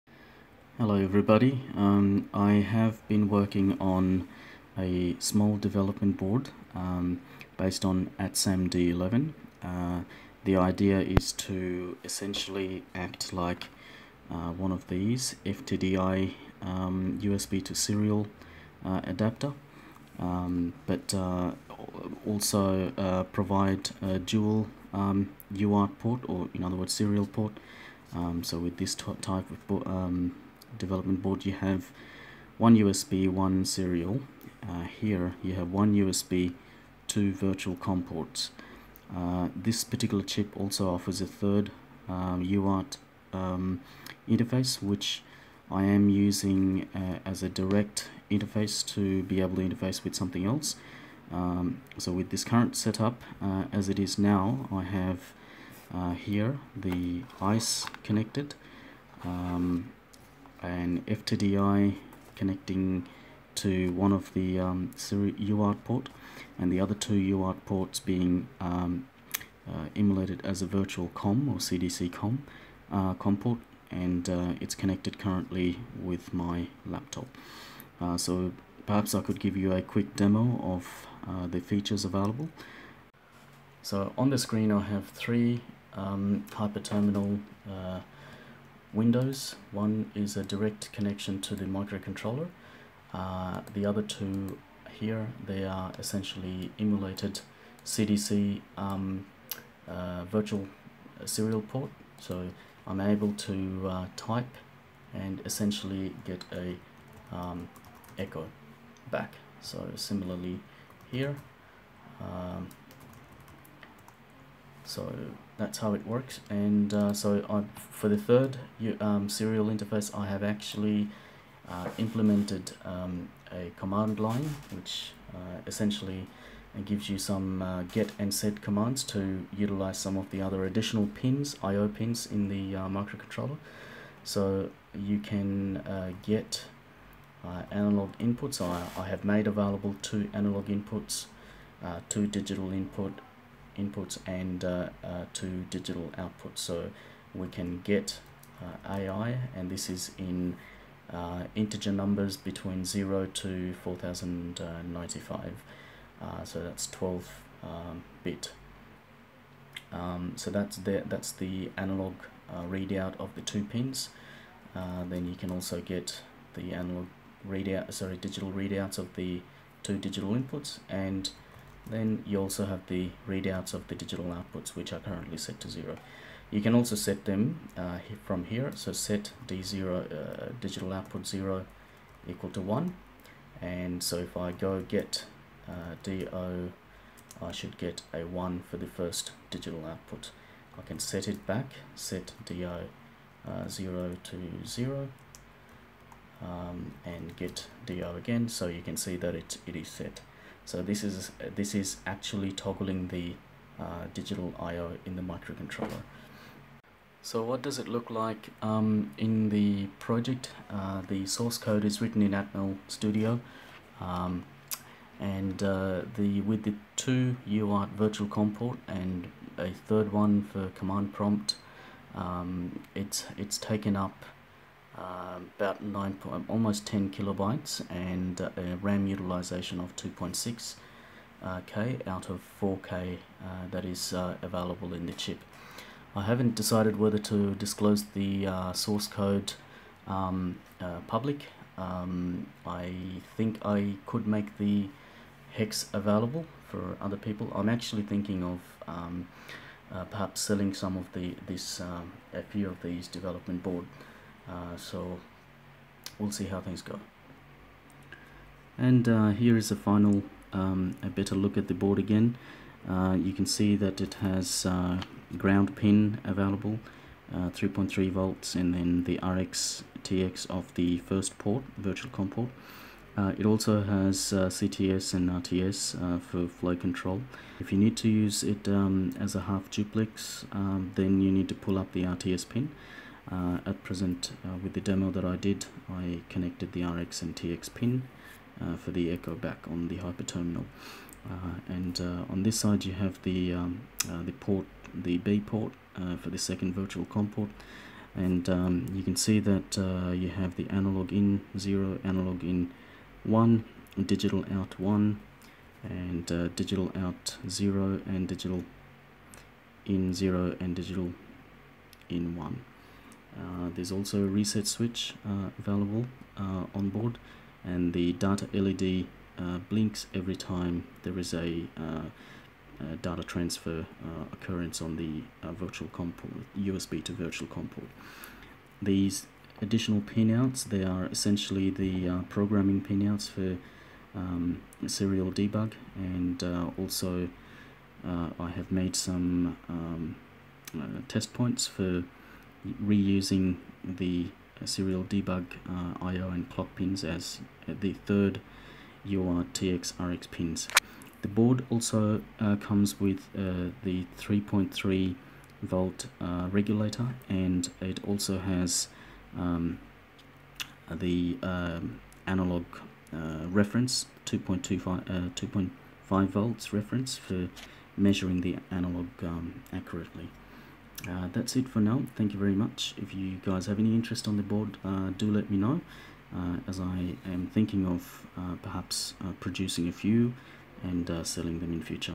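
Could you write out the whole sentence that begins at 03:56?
I haven't decided whether to disclose the source code um, public.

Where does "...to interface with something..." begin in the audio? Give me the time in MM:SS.
00:49.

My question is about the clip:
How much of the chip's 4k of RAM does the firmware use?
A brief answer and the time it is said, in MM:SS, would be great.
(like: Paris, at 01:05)
2.6k, at 03:49.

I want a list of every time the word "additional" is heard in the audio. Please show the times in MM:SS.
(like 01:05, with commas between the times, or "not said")
02:10, 05:29.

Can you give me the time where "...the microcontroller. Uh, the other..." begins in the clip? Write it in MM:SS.
01:31.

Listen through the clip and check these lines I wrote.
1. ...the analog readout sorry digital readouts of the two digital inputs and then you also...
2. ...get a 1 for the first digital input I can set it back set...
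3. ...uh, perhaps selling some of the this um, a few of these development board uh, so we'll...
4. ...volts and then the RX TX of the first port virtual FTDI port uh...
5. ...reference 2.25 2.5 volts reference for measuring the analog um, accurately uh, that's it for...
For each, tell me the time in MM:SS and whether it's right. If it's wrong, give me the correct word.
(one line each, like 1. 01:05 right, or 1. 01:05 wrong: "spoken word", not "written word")
1. 02:46 right
2. 03:07 wrong: "output", not "input"
3. 04:09 right
4. 04:28 wrong: "COM", not "FTDI"
5. 06:03 right.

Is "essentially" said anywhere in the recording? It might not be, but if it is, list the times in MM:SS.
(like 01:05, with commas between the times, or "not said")
00:12, 01:35, 01:45, 02:05, 05:31.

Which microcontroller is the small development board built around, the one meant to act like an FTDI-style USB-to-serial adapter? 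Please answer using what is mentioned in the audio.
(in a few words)
ATSAM D11.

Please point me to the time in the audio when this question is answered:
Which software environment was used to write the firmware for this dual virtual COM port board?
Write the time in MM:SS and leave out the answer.
03:32.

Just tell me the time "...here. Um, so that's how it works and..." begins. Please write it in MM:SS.
01:51.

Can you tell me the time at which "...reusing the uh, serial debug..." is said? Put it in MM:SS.
05:42.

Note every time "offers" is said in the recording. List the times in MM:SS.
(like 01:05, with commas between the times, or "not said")
00:40.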